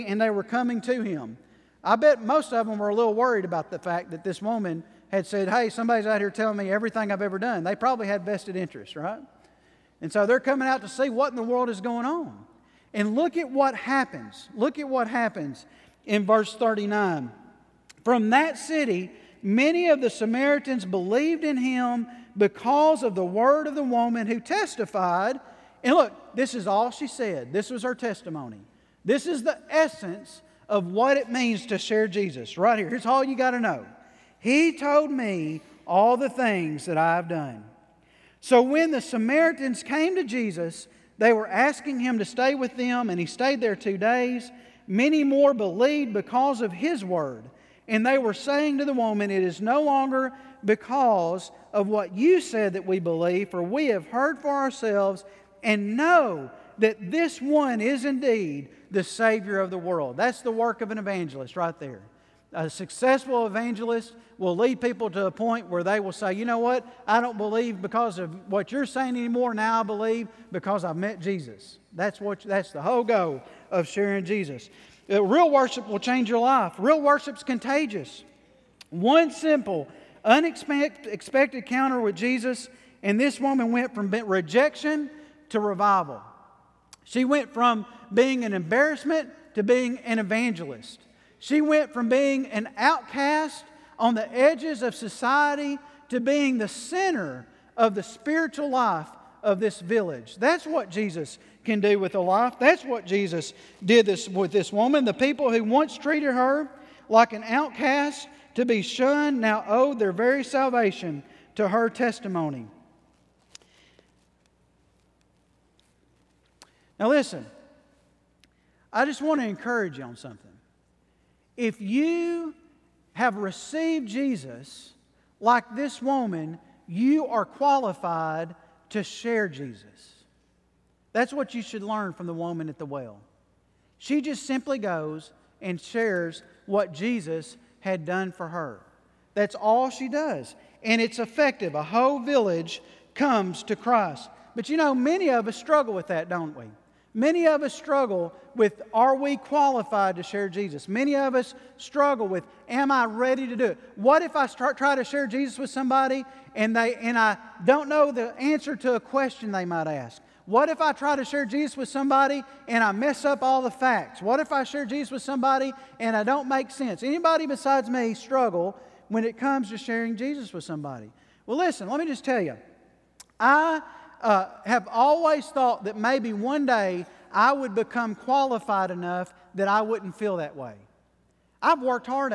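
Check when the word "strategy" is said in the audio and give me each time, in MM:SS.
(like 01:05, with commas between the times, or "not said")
not said.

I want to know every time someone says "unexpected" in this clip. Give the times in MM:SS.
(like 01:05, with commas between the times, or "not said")
01:20.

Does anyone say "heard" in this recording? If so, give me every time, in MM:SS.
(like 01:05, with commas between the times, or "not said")
00:54.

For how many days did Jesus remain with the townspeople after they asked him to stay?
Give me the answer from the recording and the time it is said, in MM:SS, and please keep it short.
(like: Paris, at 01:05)
2, at 00:43.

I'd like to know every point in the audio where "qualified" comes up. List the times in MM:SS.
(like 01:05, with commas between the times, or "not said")
02:07, 02:29, 02:58.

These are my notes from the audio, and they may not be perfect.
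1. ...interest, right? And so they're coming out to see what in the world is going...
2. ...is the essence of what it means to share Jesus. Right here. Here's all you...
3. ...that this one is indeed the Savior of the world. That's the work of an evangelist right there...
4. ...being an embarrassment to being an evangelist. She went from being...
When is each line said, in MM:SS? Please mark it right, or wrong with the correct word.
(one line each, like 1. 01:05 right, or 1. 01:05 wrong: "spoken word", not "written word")
1. 00:08 right
2. 00:29 right
3. 00:56 right
4. 01:28 right.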